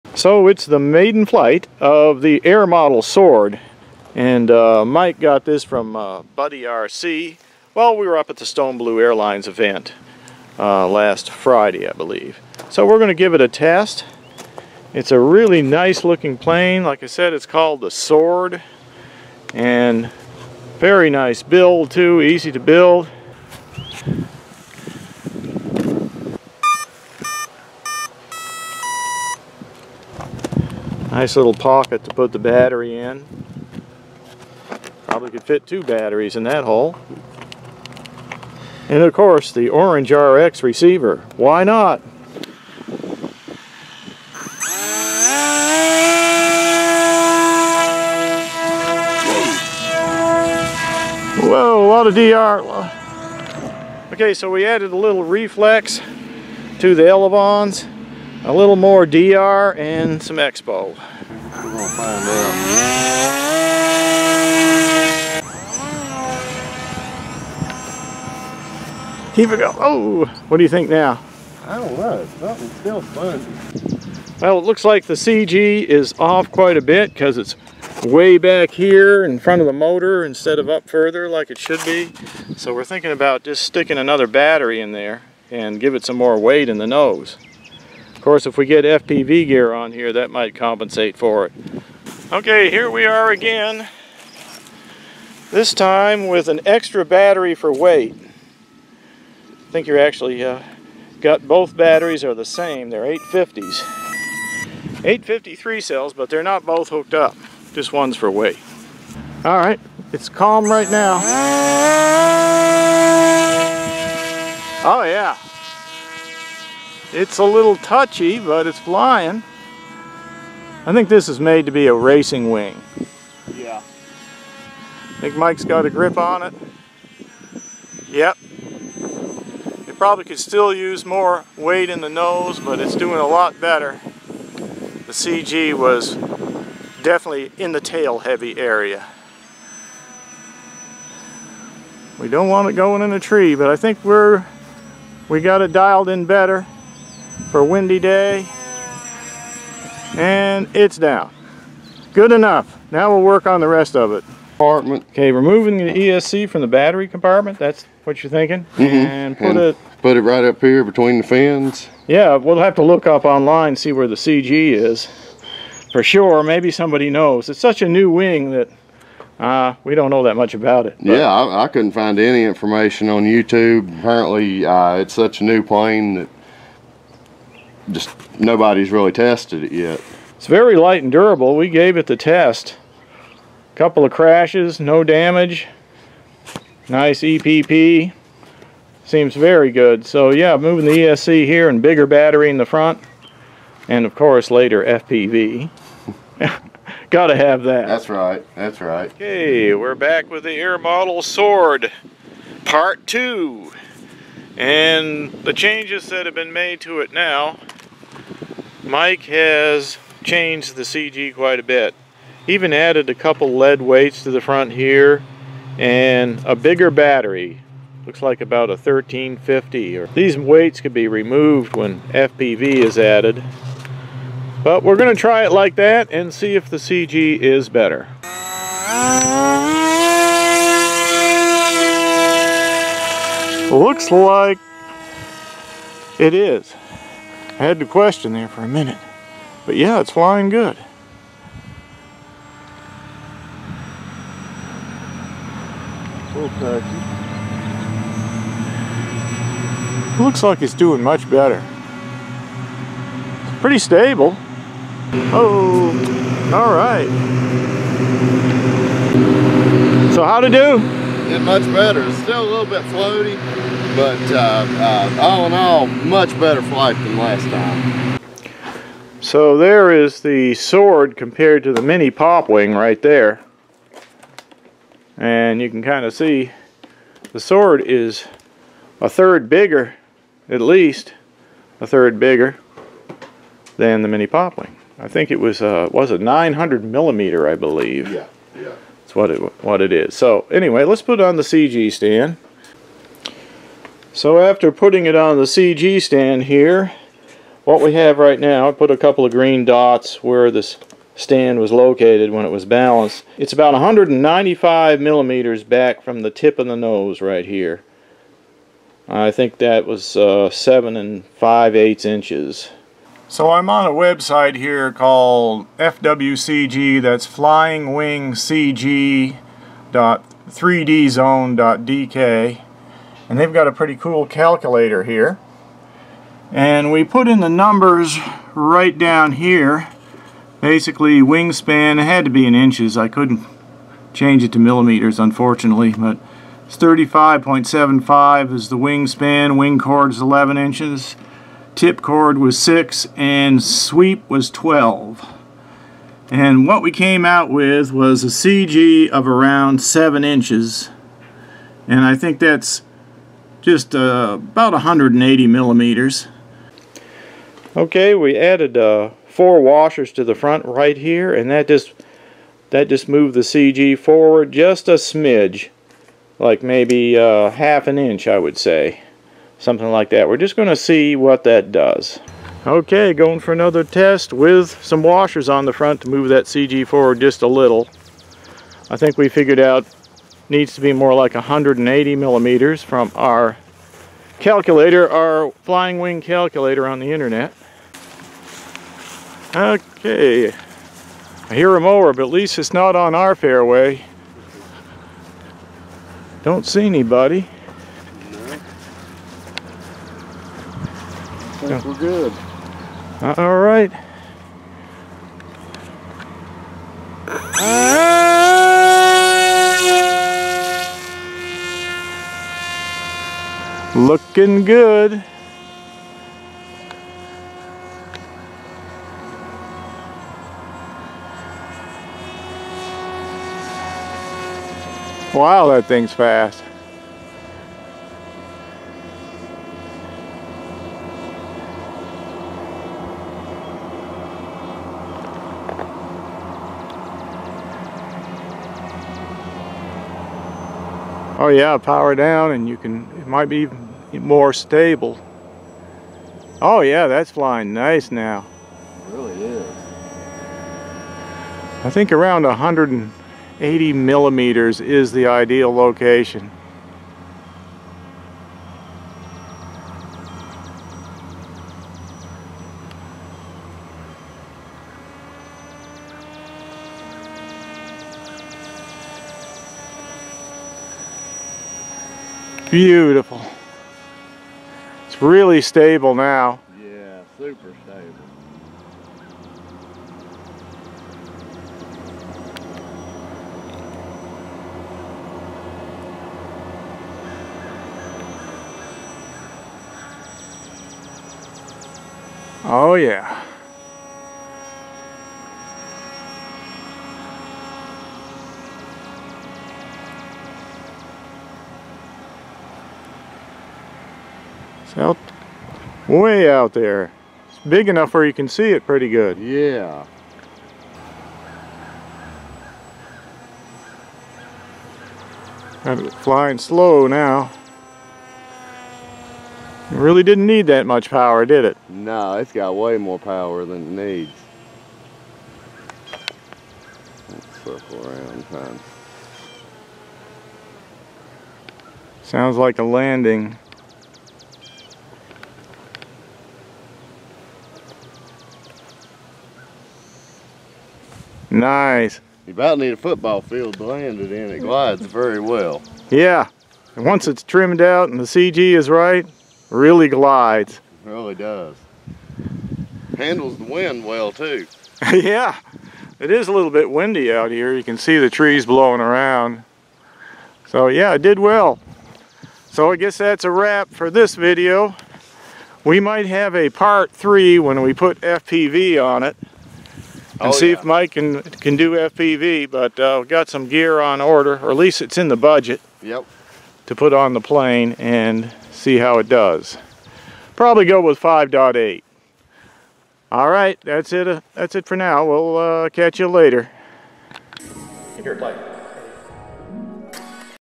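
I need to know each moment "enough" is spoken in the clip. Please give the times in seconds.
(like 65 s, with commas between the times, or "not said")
152 s, 507 s.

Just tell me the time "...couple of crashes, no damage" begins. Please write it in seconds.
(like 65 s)
183 s.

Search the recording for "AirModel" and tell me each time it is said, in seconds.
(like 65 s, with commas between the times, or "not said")
2 s, 200 s.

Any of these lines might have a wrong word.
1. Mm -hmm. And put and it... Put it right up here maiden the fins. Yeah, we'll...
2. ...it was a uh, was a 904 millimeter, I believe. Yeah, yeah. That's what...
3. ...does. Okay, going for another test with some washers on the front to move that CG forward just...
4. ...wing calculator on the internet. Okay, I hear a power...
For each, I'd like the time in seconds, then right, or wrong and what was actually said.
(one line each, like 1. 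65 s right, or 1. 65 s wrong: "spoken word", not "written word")
1. 158 s wrong: "between", not "maiden"
2. 285 s wrong: "900", not "904"
3. 371 s right
4. 385 s wrong: "mower", not "power".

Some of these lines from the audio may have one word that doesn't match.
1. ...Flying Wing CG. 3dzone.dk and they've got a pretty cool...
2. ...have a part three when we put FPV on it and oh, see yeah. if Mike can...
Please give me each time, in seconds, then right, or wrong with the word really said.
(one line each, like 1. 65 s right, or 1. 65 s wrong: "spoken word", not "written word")
1. 317 s right
2. 566 s right.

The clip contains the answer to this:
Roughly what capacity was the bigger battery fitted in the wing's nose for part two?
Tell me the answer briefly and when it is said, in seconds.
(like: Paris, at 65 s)
1350, at 218 s.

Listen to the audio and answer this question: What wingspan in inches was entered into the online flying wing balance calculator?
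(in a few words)
35.75.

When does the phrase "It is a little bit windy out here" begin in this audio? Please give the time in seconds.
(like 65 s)
556 s.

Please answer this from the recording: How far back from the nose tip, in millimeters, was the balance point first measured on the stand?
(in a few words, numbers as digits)
195 millimeters.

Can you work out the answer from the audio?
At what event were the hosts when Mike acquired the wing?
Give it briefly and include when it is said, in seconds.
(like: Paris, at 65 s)
Stone Blue Airlines event, at 8 s.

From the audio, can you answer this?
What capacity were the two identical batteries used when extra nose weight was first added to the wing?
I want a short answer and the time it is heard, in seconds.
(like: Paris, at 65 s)
850, at 103 s.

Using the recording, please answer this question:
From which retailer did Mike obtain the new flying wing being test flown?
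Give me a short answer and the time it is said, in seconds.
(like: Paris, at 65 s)
BuddyRC, at 6 s.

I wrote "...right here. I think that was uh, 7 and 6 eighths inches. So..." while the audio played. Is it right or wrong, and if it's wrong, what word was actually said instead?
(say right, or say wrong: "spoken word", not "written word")
wrong: "5", not "6".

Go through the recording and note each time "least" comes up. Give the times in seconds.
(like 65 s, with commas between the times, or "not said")
280 s, 392 s, 574 s.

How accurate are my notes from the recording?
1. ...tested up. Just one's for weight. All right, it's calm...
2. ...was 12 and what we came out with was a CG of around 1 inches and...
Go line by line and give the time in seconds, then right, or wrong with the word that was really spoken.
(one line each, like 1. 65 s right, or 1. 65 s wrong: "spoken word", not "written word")
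1. 106 s wrong: "hooked", not "tested"
2. 344 s wrong: "7", not "1".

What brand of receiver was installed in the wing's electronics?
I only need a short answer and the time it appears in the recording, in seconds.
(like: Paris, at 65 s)
OrangeRx, at 39 s.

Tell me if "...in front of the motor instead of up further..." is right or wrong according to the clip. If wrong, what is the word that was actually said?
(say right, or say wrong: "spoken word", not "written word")
right.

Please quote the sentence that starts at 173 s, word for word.
Apparently, uh, it's such a new plane that just nobody's really tested it yet.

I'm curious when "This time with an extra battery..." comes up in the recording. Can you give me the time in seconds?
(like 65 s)
95 s.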